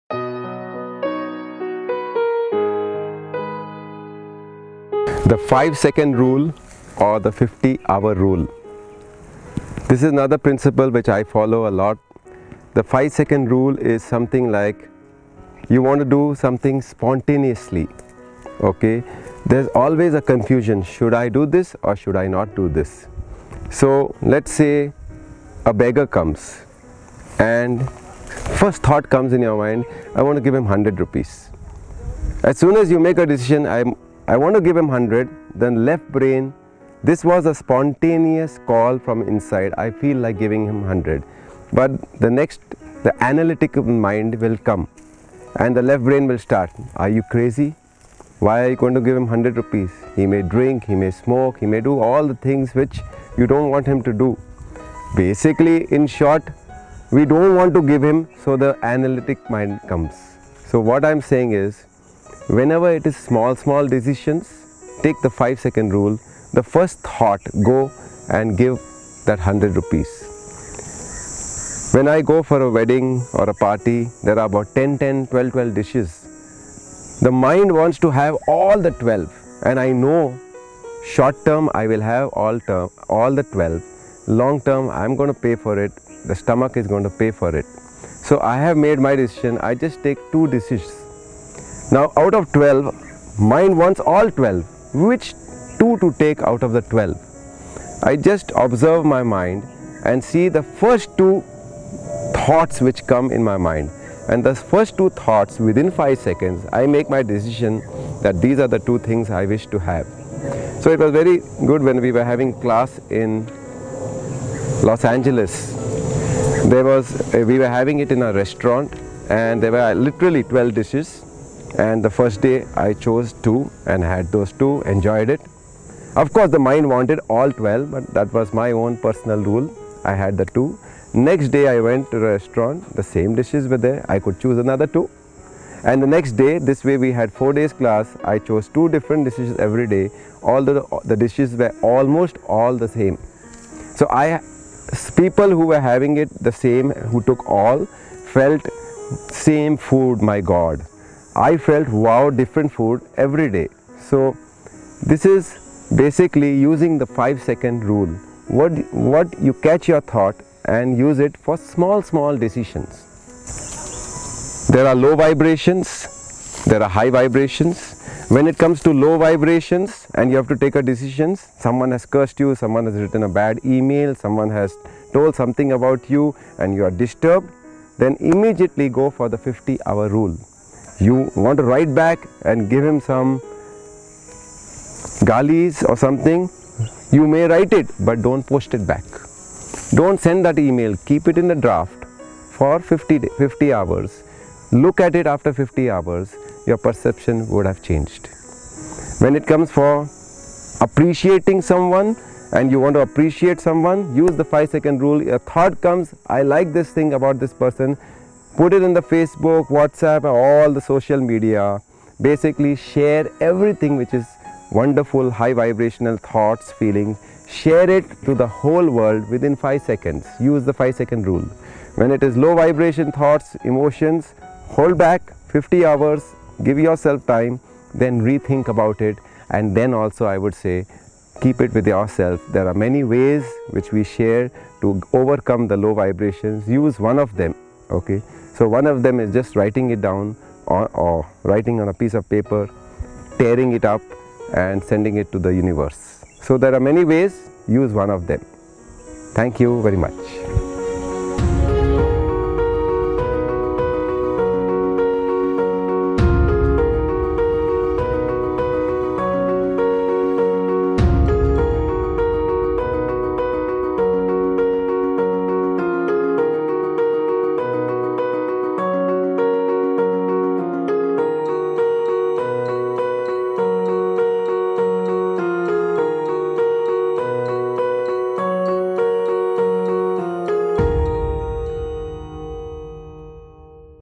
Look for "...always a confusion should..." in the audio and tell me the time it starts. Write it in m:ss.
0:19.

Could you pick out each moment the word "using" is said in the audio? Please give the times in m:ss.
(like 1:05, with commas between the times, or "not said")
2:36.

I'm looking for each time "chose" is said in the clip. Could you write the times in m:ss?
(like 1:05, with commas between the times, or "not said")
2:02, 2:18.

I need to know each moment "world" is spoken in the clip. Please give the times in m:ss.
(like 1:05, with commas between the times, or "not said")
3:38.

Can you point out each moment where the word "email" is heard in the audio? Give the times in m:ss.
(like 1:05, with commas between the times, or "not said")
2:53, 3:10.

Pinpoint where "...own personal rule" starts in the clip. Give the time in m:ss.
2:08.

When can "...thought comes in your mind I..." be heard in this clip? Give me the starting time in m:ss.
0:28.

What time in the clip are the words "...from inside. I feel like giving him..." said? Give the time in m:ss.
0:38.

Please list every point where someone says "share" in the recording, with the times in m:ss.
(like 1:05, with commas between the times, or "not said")
3:32, 3:37, 3:54.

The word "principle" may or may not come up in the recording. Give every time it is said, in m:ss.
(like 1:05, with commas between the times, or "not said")
0:10.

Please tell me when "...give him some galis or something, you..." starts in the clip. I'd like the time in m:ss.
3:02.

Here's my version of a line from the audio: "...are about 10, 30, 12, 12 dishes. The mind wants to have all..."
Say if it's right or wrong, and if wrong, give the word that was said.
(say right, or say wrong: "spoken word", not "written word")
wrong: "10", not "30".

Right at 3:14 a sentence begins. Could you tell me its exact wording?
Look at it after 50 hours, your perception would have changed.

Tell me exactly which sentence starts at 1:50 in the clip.
So it was very good when we were having class in Los Angeles.